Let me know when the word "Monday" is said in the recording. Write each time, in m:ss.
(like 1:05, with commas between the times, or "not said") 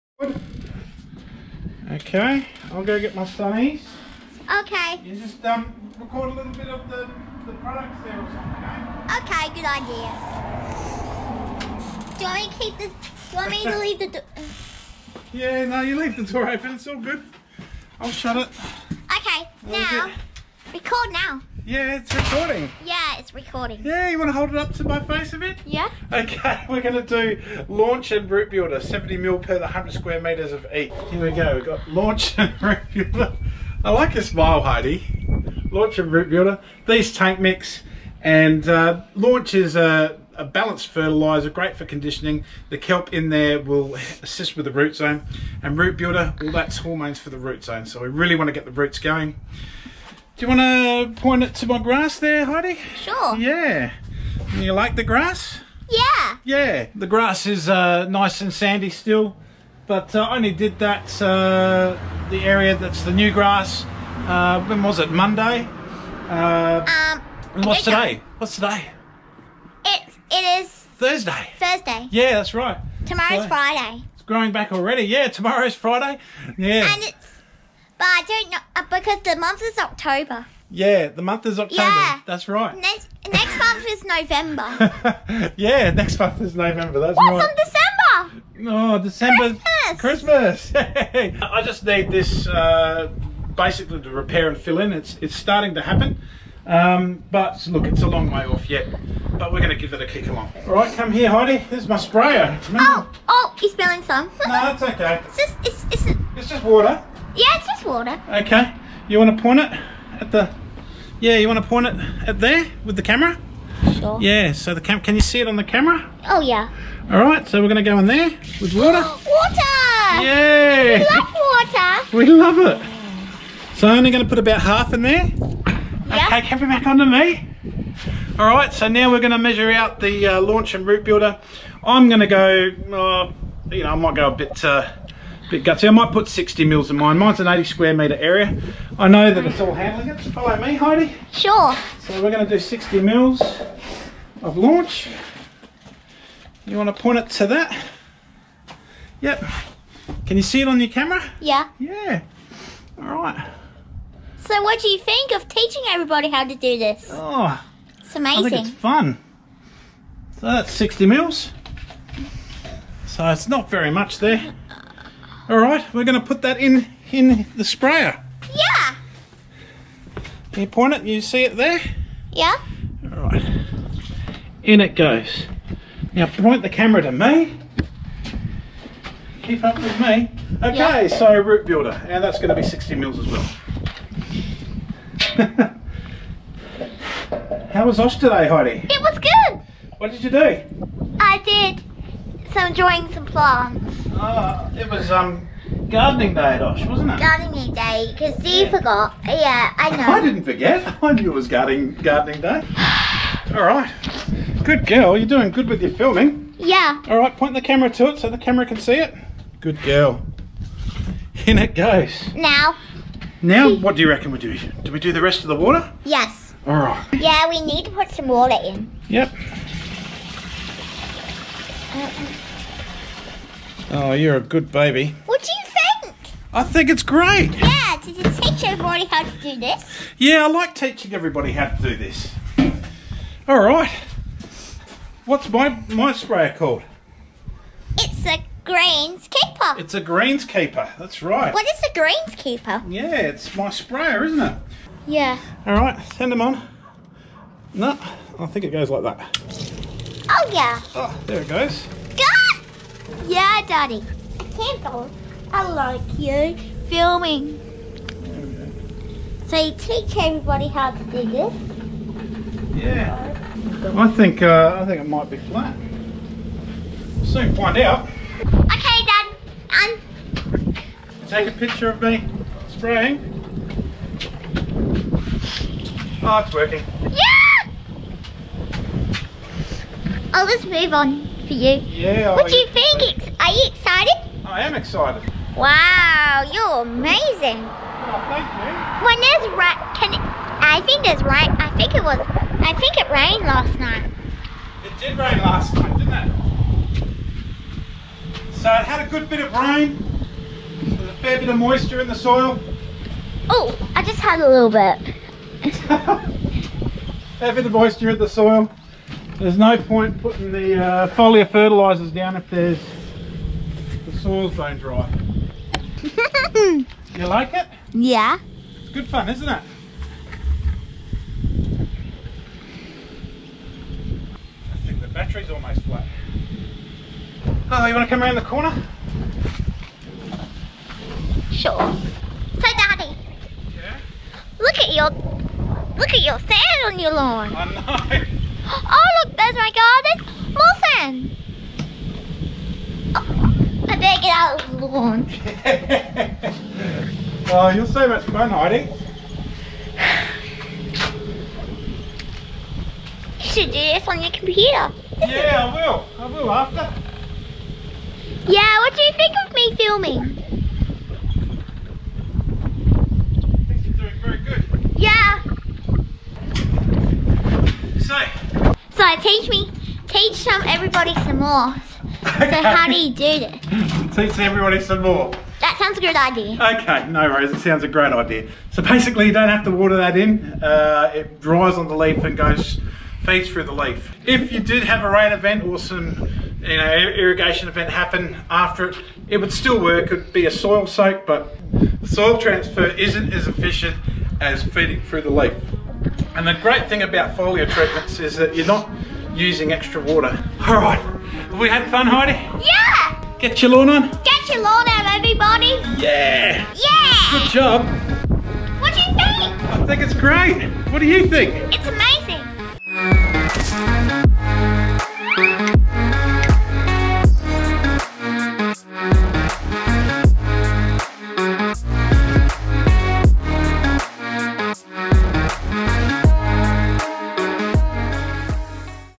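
1:05.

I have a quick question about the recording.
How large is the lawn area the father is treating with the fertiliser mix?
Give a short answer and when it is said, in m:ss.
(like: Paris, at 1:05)
80 square metres, at 2:17.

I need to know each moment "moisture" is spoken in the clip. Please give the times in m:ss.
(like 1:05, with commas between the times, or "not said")
5:01, 5:07.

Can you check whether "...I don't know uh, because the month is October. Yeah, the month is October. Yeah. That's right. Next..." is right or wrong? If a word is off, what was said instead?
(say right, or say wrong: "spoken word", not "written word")
right.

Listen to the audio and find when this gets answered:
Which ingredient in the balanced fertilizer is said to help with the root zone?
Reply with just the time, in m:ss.
0:42.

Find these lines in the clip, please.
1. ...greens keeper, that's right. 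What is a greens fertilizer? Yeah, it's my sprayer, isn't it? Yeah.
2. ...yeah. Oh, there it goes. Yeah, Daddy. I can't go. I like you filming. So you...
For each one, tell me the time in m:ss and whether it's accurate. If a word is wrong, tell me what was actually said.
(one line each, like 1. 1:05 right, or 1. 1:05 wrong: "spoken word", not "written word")
1. 3:59 wrong: "keeper", not "fertilizer"
2. 4:10 right.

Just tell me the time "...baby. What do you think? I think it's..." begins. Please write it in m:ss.
3:44.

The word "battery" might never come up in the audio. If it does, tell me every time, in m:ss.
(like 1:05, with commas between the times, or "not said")
5:25.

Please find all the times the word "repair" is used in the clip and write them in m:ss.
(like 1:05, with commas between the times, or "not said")
1:34.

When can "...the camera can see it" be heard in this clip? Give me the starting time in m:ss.
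3:28.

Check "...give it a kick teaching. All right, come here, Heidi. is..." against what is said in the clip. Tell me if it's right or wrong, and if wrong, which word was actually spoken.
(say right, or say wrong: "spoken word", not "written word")
wrong: "along", not "teaching".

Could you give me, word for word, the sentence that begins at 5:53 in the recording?
You should do this on your computer.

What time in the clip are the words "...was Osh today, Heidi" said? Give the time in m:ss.
3:07.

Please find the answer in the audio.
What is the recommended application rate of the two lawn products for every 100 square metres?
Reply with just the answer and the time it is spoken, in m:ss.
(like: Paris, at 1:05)
70 ml, at 0:28.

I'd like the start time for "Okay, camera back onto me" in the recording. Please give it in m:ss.
2:06.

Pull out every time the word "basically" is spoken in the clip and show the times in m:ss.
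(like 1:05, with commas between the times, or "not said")
1:33, 6:18.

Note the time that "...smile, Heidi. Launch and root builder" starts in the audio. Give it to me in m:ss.
0:34.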